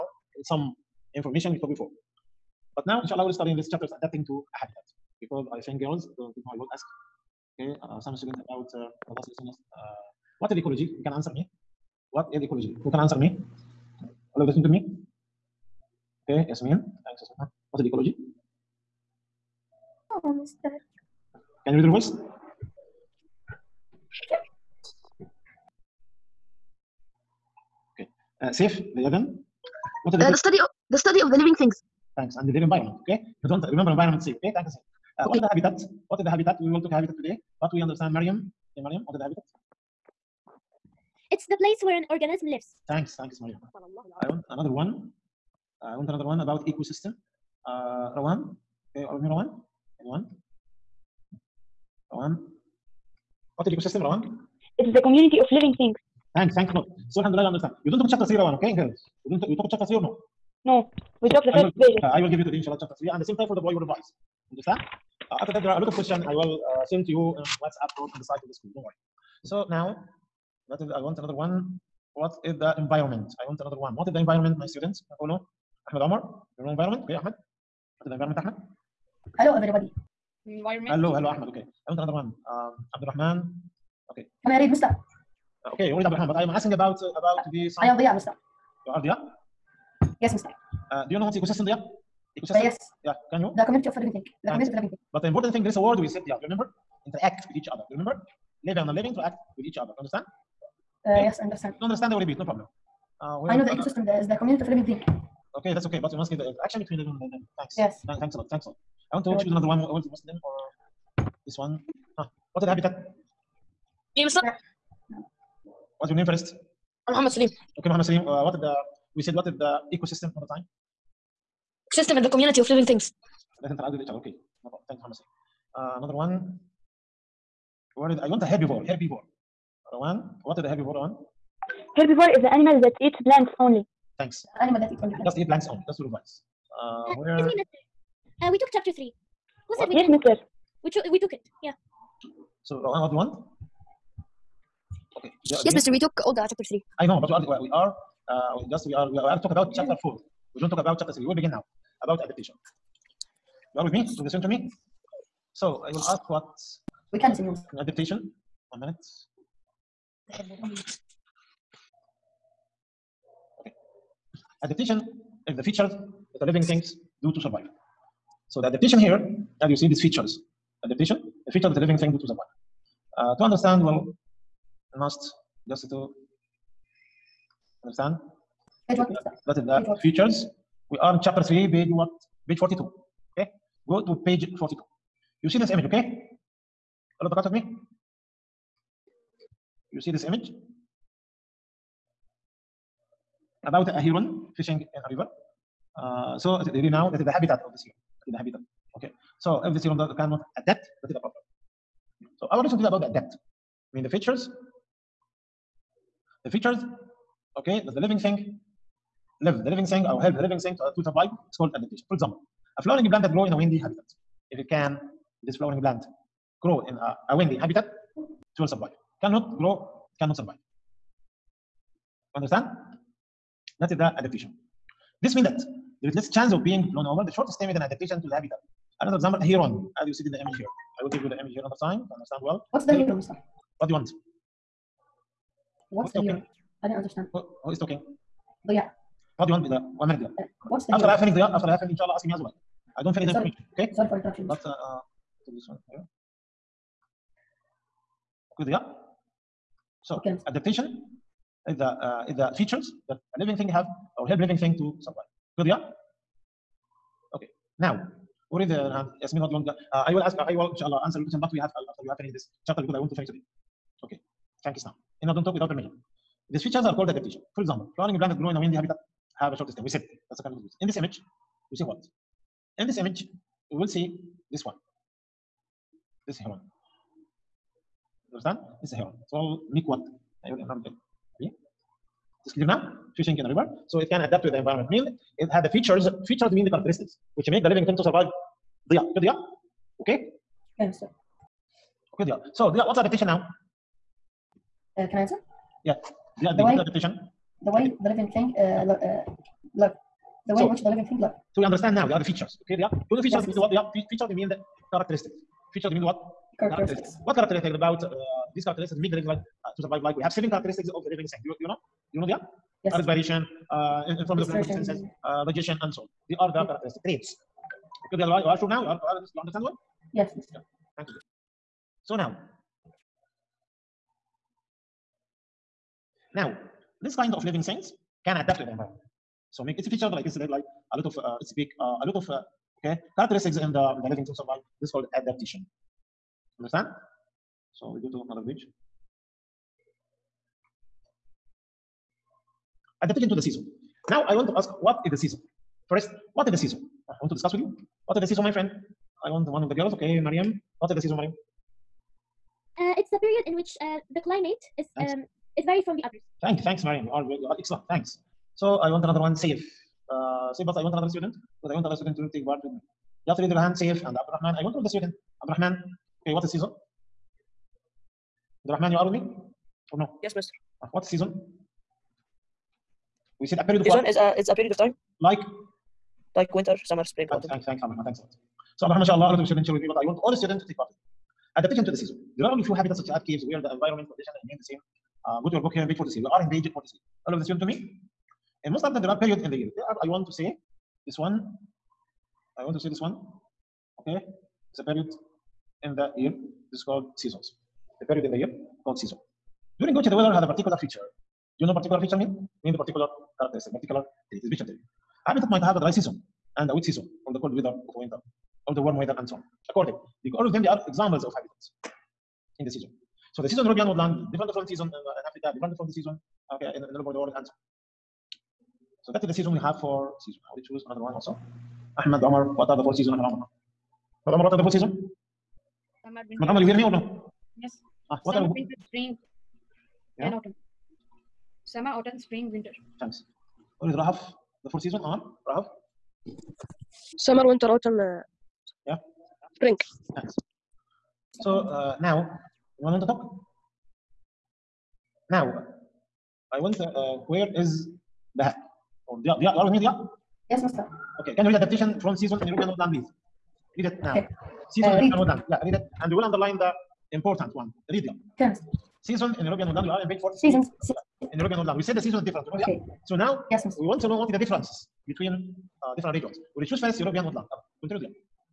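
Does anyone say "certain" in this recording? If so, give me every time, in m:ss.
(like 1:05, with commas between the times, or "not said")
not said.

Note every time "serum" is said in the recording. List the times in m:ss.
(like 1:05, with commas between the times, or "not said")
3:19.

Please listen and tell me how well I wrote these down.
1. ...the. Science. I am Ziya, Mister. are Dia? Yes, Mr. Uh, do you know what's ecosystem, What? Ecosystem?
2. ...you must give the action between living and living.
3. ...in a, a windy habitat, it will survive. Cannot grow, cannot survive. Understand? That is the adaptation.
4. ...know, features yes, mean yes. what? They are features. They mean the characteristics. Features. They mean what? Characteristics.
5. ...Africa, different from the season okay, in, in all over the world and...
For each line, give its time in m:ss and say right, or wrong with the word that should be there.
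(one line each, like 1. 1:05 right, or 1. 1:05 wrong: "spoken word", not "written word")
1. 1:27 wrong: "Dia", not "What"
2. 1:46 right
3. 3:36 right
4. 5:03 right
5. 6:55 right.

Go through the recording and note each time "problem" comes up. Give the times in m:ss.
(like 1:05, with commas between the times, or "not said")
1:42, 2:04, 3:21.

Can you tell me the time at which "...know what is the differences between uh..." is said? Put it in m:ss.
7:44.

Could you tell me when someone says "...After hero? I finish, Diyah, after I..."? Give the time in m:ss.
4:00.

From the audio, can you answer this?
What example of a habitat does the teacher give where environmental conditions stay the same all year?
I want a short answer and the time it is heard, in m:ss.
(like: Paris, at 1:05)
Caves, at 6:23.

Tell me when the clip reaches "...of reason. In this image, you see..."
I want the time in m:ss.
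4:30.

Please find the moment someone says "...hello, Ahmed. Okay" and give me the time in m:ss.
1:21.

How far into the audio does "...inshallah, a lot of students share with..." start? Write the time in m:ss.
6:19.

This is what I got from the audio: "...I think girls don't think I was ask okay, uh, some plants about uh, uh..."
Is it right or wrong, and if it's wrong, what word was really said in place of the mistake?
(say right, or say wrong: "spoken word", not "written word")
wrong: "students", not "plants".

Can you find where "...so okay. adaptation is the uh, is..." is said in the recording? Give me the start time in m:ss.
4:10.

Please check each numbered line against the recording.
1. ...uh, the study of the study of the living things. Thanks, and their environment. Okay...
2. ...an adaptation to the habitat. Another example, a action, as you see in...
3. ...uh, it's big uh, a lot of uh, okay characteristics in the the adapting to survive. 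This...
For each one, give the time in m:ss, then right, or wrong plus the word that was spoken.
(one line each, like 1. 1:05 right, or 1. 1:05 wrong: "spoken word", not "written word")
1. 0:30 right
2. 3:47 wrong: "heron", not "action"
3. 5:31 wrong: "living", not "adapting".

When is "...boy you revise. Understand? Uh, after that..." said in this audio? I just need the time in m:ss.
1:03.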